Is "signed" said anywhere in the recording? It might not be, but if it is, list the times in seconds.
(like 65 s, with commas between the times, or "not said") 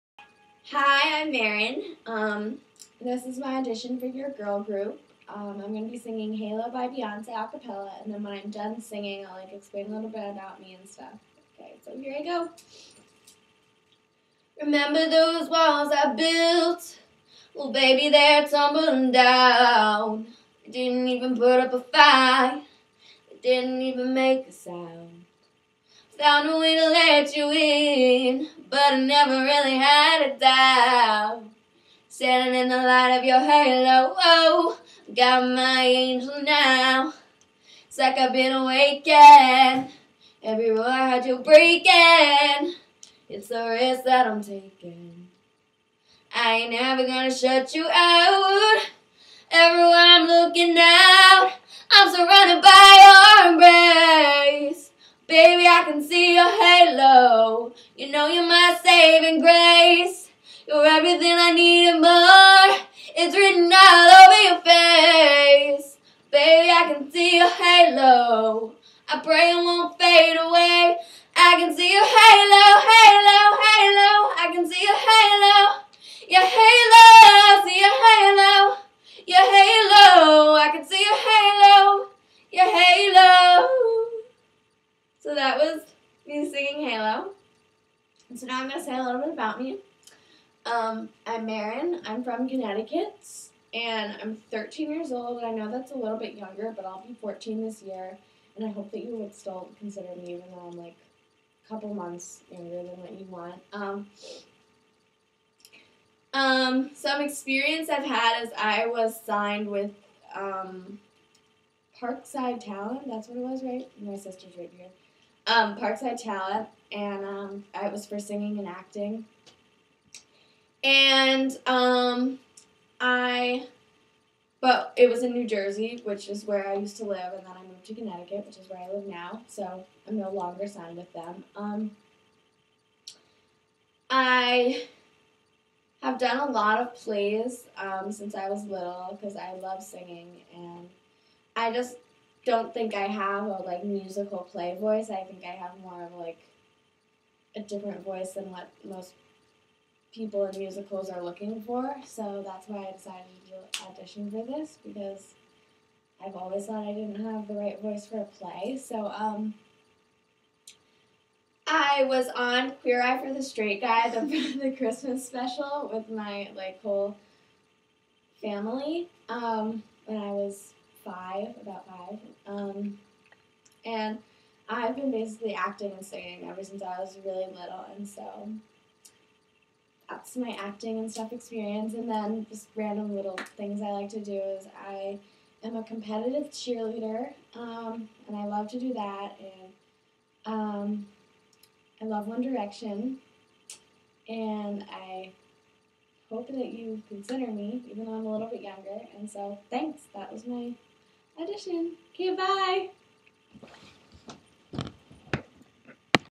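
109 s, 130 s.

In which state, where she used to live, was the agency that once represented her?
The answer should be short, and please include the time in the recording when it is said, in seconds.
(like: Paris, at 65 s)
New Jersey, at 125 s.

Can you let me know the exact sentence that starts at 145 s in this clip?
I think I have more of like a different voice than what most people in musicals are looking for.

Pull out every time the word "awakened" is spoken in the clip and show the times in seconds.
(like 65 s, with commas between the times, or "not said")
38 s.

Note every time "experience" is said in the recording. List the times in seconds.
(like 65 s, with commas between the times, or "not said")
107 s, 181 s.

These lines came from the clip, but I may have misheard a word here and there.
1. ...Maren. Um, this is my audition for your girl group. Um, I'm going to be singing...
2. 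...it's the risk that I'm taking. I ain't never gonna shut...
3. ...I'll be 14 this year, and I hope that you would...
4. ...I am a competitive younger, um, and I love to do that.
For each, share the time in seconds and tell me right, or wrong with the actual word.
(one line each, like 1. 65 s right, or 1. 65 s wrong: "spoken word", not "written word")
1. 1 s right
2. 43 s right
3. 96 s right
4. 184 s wrong: "cheerleader", not "younger".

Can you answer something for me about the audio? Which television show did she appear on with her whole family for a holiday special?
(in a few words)
Queer Eye for the Straight Guy.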